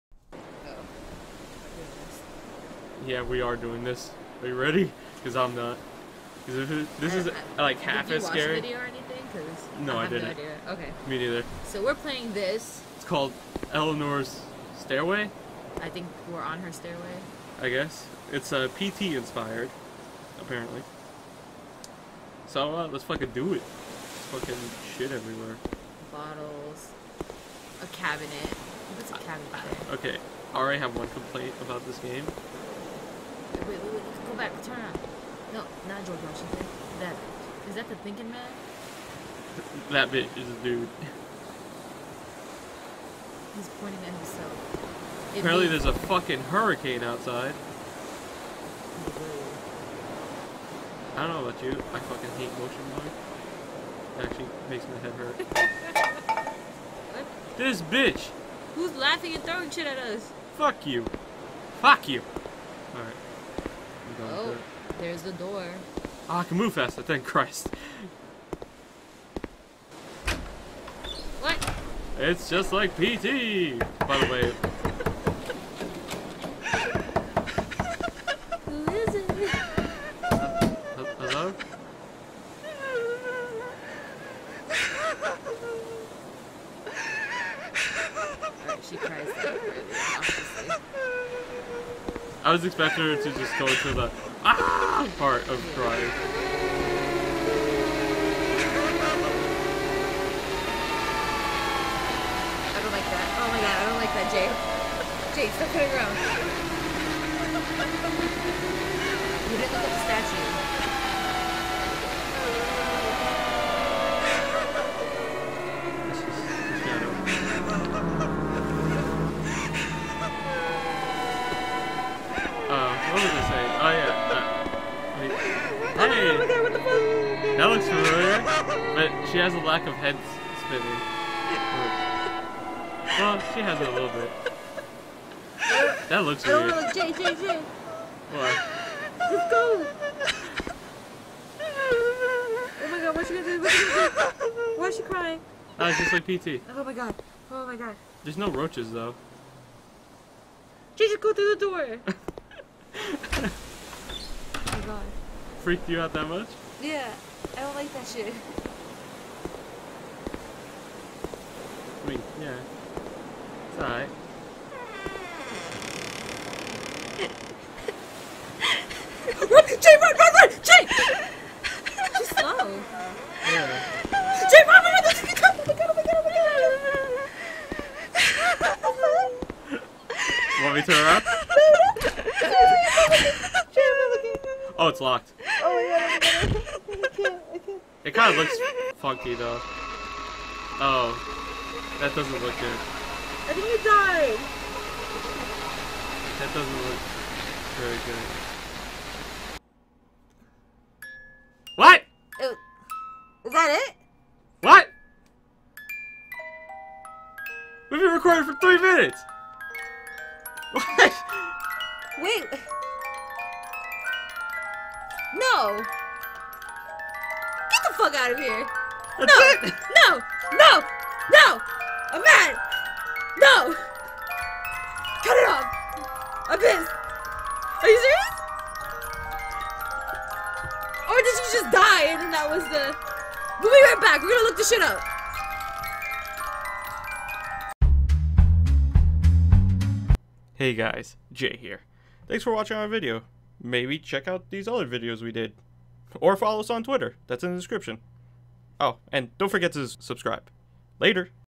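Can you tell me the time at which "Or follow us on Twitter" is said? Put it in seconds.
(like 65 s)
246 s.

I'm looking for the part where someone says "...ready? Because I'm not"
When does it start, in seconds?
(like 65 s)
4 s.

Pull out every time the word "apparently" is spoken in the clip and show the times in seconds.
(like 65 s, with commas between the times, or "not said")
20 s, 45 s.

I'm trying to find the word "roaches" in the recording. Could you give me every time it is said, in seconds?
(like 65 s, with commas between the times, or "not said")
148 s.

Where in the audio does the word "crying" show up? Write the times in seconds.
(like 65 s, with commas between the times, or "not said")
95 s, 145 s.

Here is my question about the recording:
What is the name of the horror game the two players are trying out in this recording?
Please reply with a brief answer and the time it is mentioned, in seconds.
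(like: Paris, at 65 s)
Eleanor's Stairway, at 13 s.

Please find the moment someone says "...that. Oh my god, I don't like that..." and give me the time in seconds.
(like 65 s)
103 s.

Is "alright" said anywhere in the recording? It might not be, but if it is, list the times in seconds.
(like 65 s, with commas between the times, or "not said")
62 s, 163 s.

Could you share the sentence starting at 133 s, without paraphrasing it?
Well, she has it a little bit.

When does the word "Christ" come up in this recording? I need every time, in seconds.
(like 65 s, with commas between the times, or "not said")
67 s.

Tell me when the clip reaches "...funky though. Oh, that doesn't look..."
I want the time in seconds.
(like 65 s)
188 s.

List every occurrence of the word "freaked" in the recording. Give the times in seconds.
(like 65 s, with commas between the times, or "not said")
155 s.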